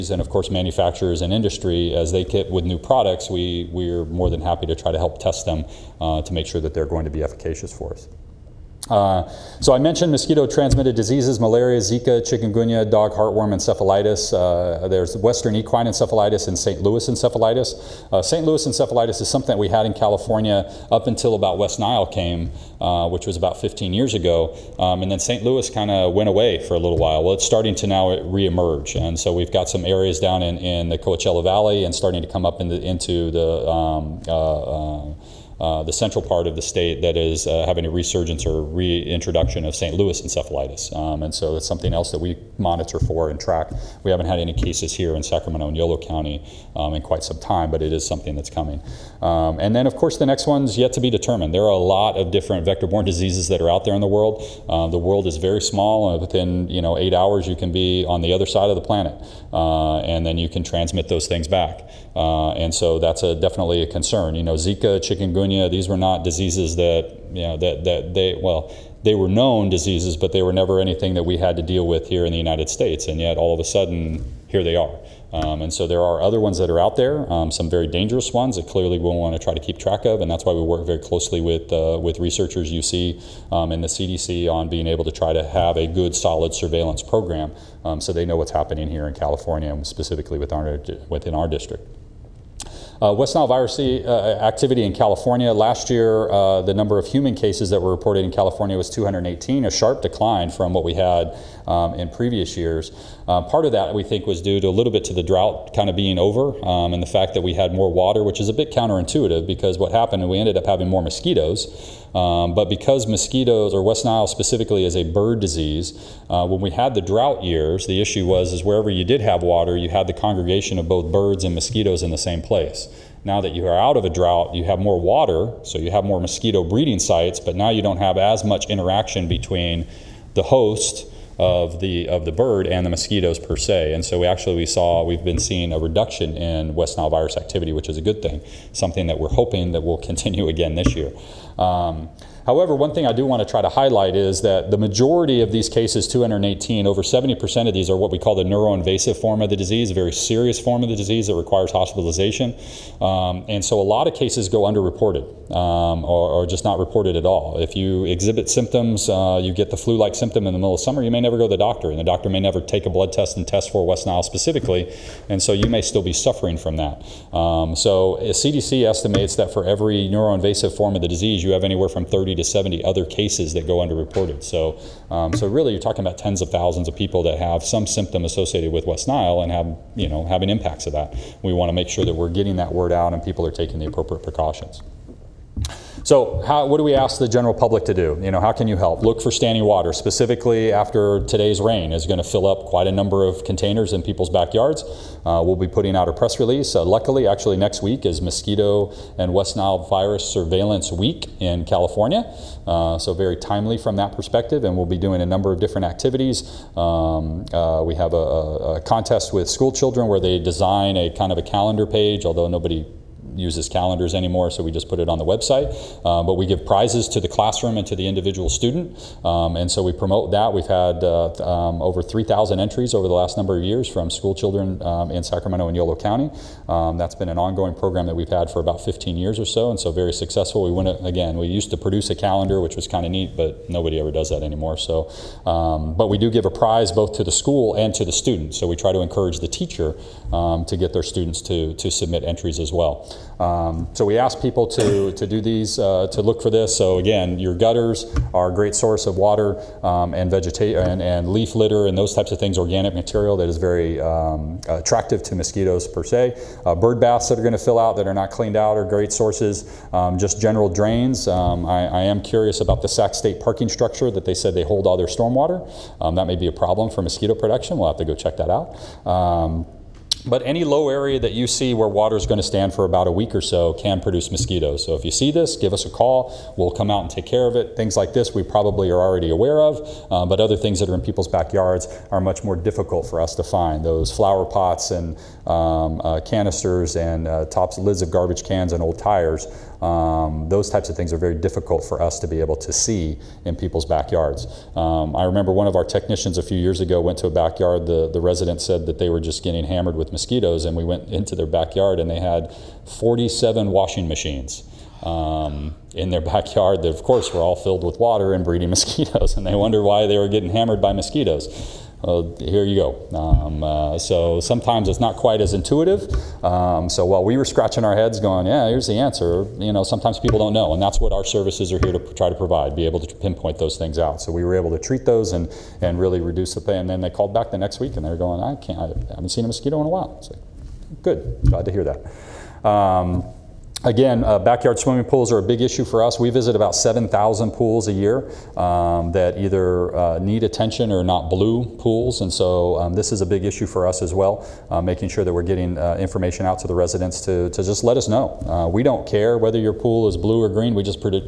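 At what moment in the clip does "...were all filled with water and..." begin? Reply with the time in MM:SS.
05:07.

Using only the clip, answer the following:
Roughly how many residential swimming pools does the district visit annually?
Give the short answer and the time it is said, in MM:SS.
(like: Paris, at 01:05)
7,000, at 05:36.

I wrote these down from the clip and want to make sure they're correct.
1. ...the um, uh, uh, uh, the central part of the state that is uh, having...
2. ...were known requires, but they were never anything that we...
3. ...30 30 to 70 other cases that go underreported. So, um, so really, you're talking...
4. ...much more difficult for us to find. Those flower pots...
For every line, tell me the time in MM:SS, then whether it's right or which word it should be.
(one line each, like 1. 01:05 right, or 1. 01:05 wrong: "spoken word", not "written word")
1. 00:33 right
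2. 01:09 wrong: "diseases", not "requires"
3. 02:52 right
4. 04:42 right.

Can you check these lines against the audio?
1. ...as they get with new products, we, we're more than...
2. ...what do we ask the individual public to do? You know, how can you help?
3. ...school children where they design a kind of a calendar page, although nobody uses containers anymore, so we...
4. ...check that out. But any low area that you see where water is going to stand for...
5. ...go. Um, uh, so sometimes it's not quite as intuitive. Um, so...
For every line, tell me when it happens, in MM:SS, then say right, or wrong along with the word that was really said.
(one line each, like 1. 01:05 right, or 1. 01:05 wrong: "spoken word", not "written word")
1. 00:01 right
2. 03:06 wrong: "general", not "individual"
3. 03:29 wrong: "calendars", not "containers"
4. 04:28 right
5. 05:12 right.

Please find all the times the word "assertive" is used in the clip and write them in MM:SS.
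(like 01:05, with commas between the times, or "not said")
not said.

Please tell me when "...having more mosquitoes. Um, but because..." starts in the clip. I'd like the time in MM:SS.
01:50.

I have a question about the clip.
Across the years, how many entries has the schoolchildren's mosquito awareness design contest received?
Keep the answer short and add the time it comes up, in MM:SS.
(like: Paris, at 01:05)
3,000, at 03:42.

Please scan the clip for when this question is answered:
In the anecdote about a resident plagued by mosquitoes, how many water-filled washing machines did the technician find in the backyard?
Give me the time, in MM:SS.
05:02.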